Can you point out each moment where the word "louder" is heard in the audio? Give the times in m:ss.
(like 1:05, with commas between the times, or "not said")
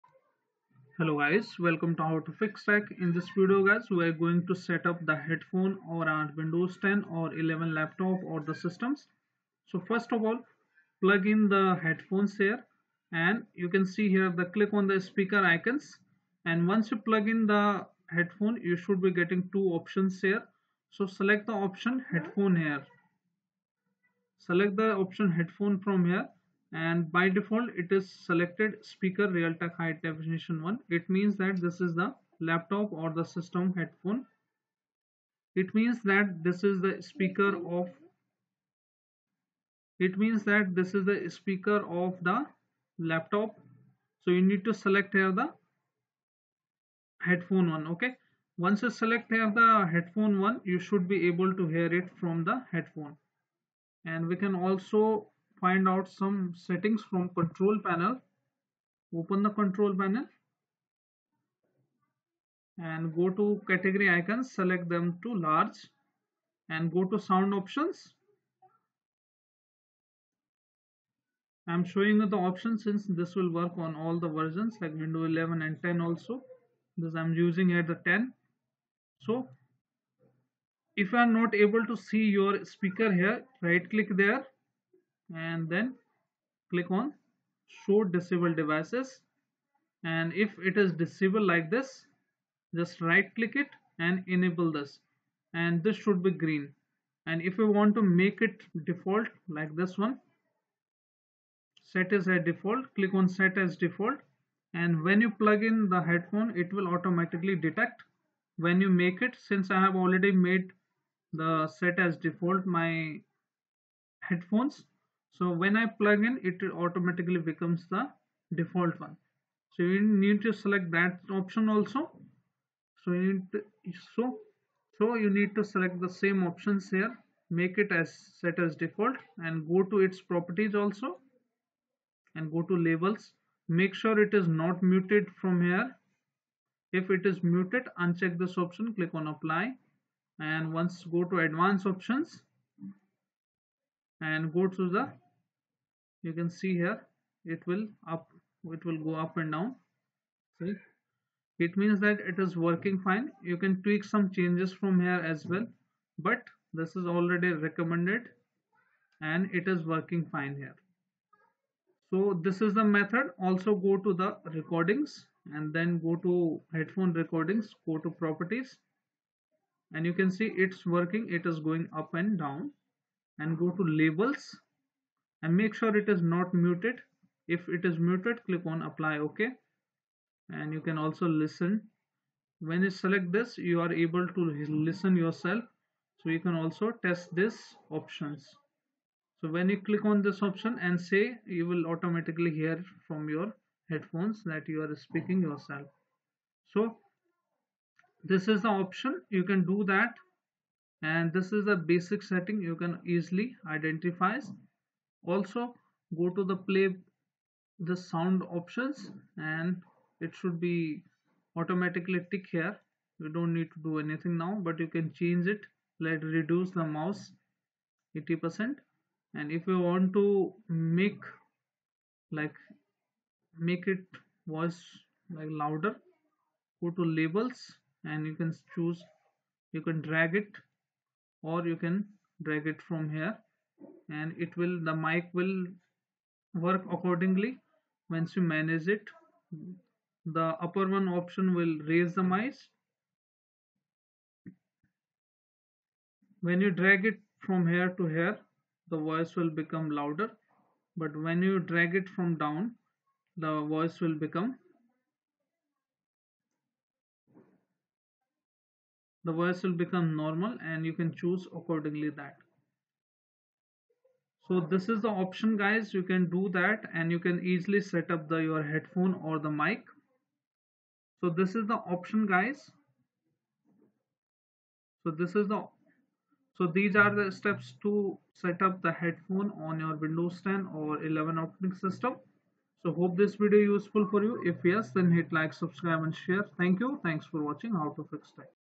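3:45, 4:10.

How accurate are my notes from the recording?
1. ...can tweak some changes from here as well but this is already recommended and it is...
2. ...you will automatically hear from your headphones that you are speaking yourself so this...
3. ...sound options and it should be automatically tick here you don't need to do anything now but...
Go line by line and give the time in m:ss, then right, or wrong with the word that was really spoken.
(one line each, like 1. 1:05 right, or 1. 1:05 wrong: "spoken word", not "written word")
1. 2:33 right
2. 3:11 right
3. 3:27 right.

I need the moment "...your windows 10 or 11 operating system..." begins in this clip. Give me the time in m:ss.
4:39.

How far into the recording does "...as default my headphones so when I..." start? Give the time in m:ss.
1:51.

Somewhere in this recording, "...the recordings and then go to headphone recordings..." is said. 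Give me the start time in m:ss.
2:44.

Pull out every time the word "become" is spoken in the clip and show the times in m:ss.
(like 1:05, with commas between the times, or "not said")
1:57, 4:09, 4:14, 4:19.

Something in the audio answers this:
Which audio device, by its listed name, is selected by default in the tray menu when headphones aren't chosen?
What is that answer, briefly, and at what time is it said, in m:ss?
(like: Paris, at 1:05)
Speaker Realtek high definition, at 0:28.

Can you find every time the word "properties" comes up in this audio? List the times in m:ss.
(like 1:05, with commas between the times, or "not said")
2:10, 2:48.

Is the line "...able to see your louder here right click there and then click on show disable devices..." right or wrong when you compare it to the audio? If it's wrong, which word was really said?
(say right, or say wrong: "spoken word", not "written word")
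wrong: "speaker", not "louder".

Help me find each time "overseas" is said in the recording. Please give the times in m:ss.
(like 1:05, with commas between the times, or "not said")
not said.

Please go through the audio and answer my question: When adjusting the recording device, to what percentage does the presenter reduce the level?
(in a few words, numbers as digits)
80 percent.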